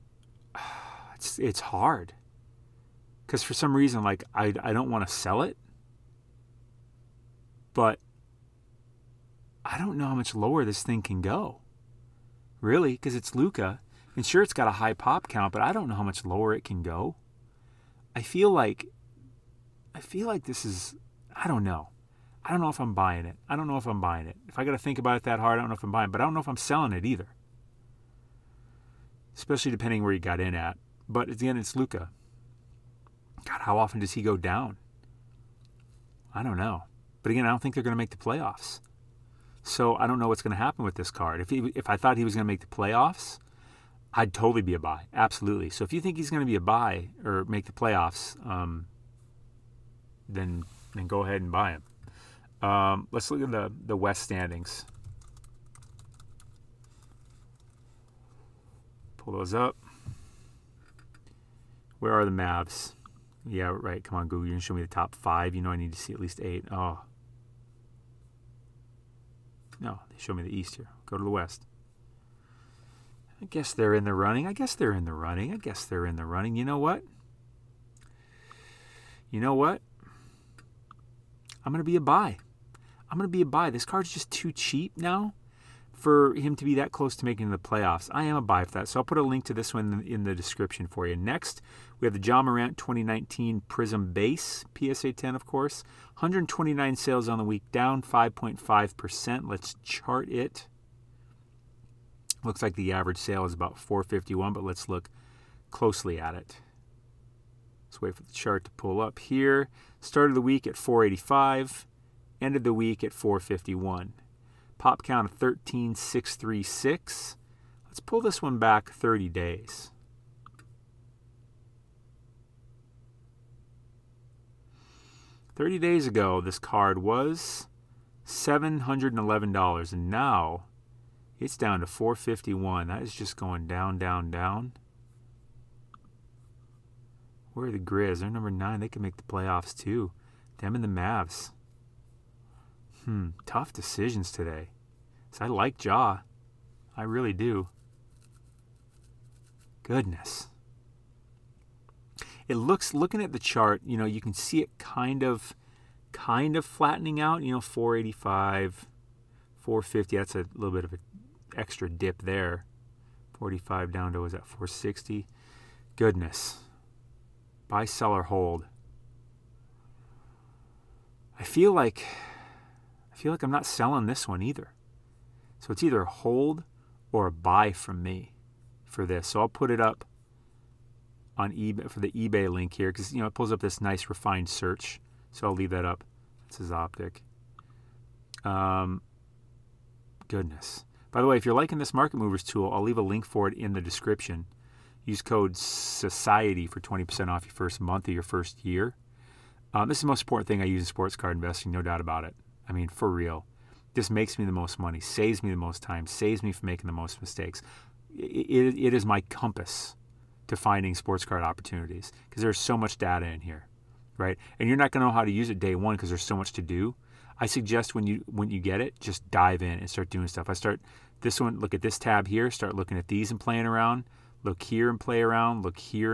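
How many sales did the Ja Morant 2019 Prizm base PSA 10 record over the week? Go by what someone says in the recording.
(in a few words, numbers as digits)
129.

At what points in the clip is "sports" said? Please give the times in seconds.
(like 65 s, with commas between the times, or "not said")
200 s, 210 s.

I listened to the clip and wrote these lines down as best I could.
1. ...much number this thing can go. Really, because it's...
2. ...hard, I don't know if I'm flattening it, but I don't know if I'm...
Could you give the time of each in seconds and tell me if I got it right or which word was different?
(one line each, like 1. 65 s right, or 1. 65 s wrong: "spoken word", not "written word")
1. 10 s wrong: "lower", not "number"
2. 25 s wrong: "buying", not "flattening".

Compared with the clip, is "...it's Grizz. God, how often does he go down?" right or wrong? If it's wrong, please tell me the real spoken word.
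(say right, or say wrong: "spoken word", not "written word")
wrong: "Luka", not "Grizz".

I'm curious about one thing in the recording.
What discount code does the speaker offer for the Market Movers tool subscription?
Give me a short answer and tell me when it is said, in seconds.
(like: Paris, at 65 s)
SOCIETY, at 195 s.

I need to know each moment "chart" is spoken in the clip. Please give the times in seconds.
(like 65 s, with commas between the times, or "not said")
99 s, 108 s, 153 s.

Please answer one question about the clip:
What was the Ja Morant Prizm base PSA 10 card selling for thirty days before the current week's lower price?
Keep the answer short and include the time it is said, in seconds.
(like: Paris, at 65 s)
$711, at 128 s.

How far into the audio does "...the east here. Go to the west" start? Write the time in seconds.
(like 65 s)
70 s.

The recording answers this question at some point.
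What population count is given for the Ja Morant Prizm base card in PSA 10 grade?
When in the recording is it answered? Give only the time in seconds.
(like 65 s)
115 s.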